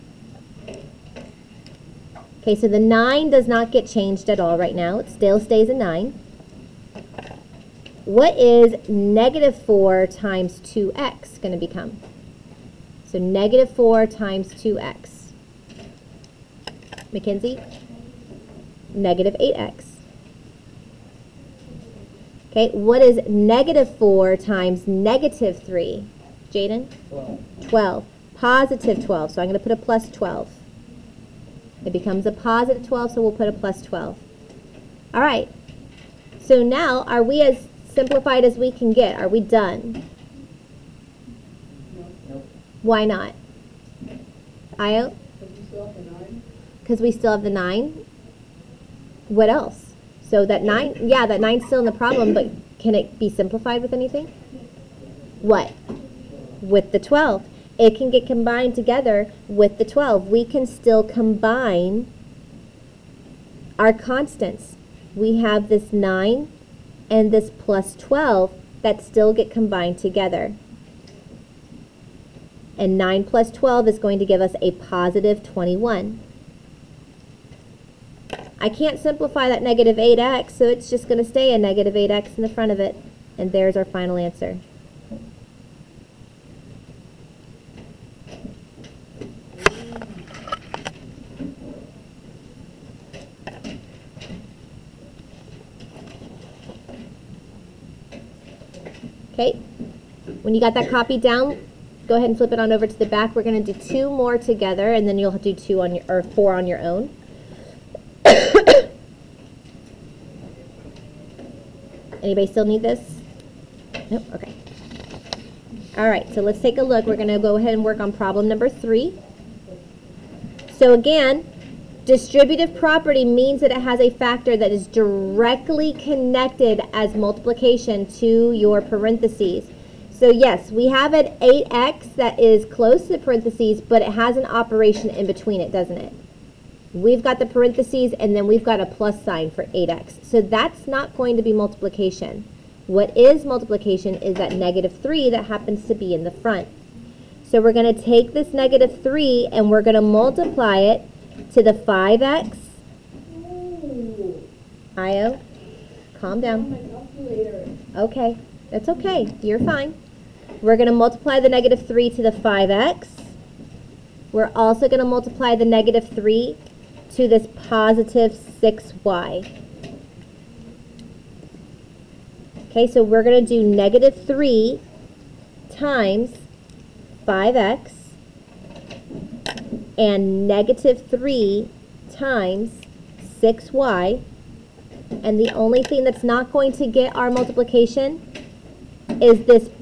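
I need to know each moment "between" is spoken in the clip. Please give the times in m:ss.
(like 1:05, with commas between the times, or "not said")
2:15.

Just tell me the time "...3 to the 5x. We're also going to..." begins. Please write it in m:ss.
2:41.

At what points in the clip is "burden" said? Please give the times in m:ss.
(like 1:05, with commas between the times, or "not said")
not said.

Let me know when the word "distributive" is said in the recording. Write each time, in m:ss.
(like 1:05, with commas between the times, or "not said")
2:02.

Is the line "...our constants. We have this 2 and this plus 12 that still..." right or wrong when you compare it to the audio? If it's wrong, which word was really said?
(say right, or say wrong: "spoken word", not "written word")
wrong: "9", not "2".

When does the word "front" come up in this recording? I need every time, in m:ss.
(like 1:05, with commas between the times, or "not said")
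1:22, 2:26.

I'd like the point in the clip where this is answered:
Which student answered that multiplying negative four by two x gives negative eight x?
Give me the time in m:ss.
0:17.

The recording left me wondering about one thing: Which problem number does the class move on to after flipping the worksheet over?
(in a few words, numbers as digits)
3.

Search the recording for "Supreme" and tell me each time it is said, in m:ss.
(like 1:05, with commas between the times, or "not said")
not said.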